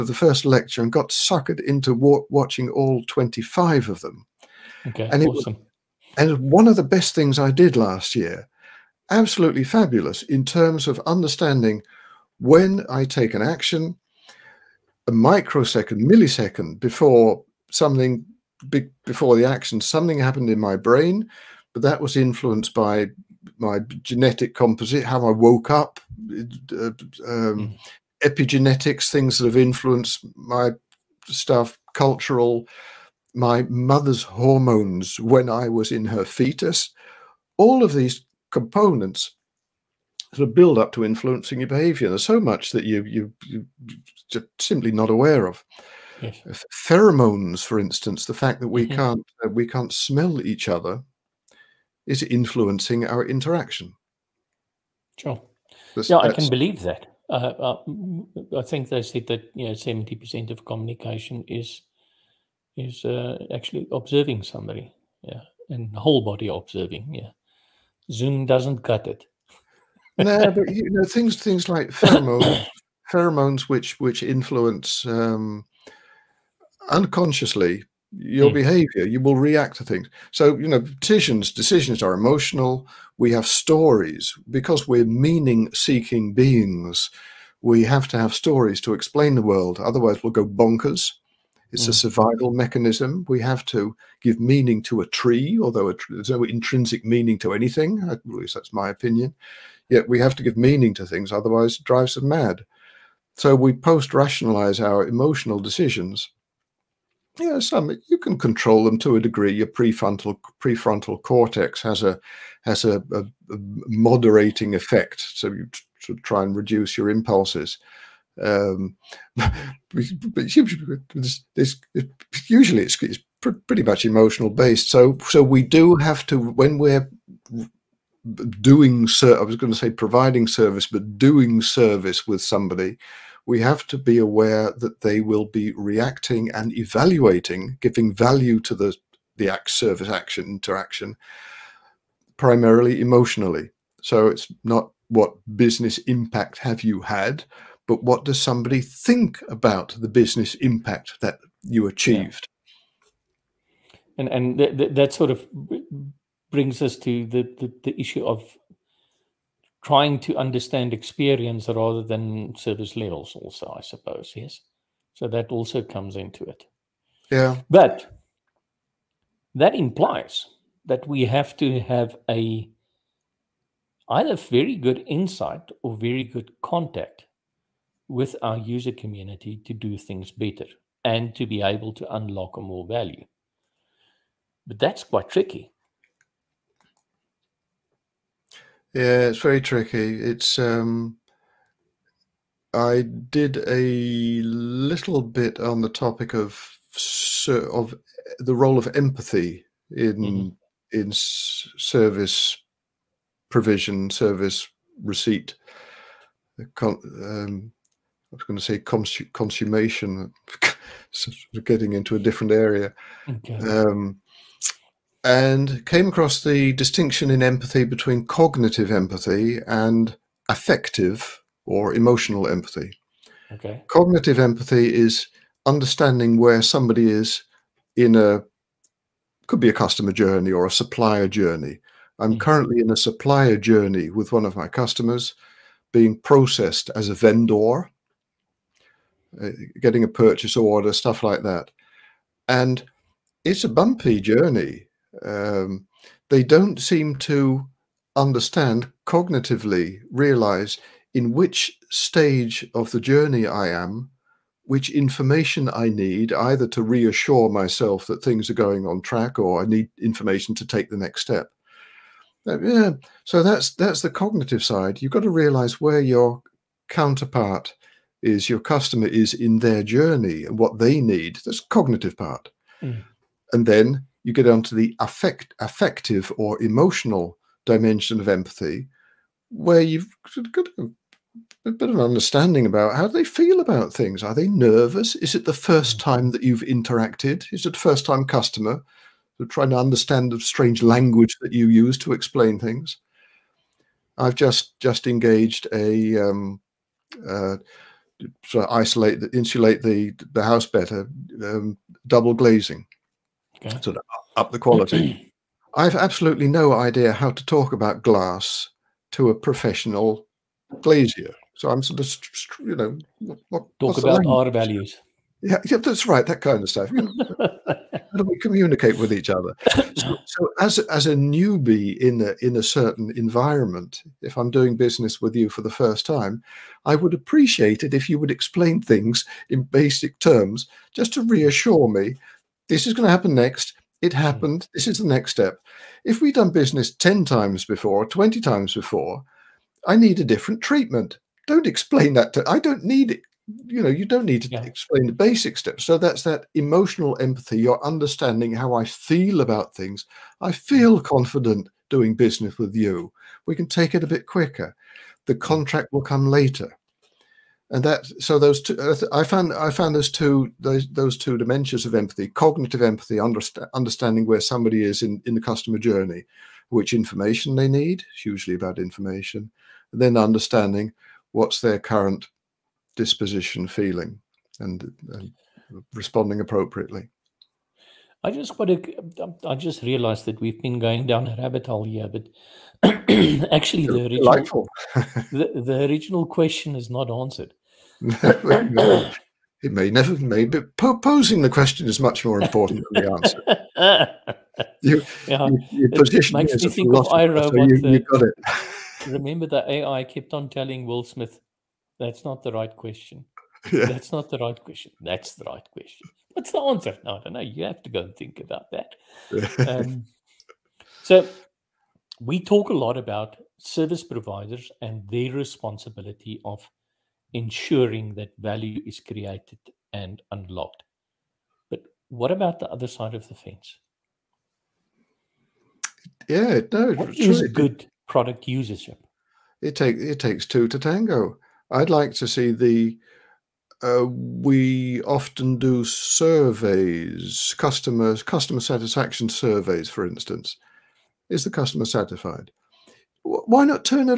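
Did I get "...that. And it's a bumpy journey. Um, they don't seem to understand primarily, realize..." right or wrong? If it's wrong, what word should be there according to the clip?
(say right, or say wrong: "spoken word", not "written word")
wrong: "cognitively", not "primarily".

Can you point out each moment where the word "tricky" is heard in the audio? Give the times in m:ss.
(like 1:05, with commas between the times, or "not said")
3:05, 3:09.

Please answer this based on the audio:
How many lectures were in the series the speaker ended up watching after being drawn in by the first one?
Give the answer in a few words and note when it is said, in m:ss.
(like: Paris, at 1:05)
25, at 0:03.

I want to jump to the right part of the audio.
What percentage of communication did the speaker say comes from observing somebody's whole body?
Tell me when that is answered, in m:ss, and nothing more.
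0:59.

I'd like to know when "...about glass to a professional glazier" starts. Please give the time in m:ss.
5:07.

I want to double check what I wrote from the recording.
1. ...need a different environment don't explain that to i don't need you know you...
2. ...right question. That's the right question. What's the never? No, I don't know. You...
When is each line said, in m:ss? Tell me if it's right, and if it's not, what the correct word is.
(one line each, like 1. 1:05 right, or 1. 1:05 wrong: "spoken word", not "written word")
1. 5:39 wrong: "treatment", not "environment"
2. 6:44 wrong: "answer", not "never".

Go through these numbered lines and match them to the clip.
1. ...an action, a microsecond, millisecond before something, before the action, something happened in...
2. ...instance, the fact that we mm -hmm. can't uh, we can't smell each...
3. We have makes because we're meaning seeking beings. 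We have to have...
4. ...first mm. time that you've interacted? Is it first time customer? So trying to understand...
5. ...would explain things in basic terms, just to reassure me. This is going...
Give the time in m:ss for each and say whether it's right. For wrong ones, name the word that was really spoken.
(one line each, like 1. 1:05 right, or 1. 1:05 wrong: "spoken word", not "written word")
1. 0:13 right
2. 0:47 right
3. 1:23 wrong: "stories", not "makes"
4. 4:45 right
5. 5:28 right.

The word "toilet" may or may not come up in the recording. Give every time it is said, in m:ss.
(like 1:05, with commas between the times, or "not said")
not said.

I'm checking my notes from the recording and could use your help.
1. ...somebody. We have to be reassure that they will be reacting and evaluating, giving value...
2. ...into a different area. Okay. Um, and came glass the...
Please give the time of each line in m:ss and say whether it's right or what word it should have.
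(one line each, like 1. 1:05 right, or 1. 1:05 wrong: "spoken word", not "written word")
1. 2:12 wrong: "aware", not "reassure"
2. 3:31 wrong: "across", not "glass".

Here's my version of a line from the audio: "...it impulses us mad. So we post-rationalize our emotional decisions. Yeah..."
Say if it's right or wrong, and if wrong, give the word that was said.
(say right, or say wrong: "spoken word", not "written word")
wrong: "drives", not "impulses".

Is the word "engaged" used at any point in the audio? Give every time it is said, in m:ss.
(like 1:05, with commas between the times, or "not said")
4:55.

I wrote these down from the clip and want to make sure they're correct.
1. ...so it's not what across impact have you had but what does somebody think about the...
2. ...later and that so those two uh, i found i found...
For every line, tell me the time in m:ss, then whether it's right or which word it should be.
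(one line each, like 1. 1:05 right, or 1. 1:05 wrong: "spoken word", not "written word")
1. 2:24 wrong: "business", not "across"
2. 5:56 right.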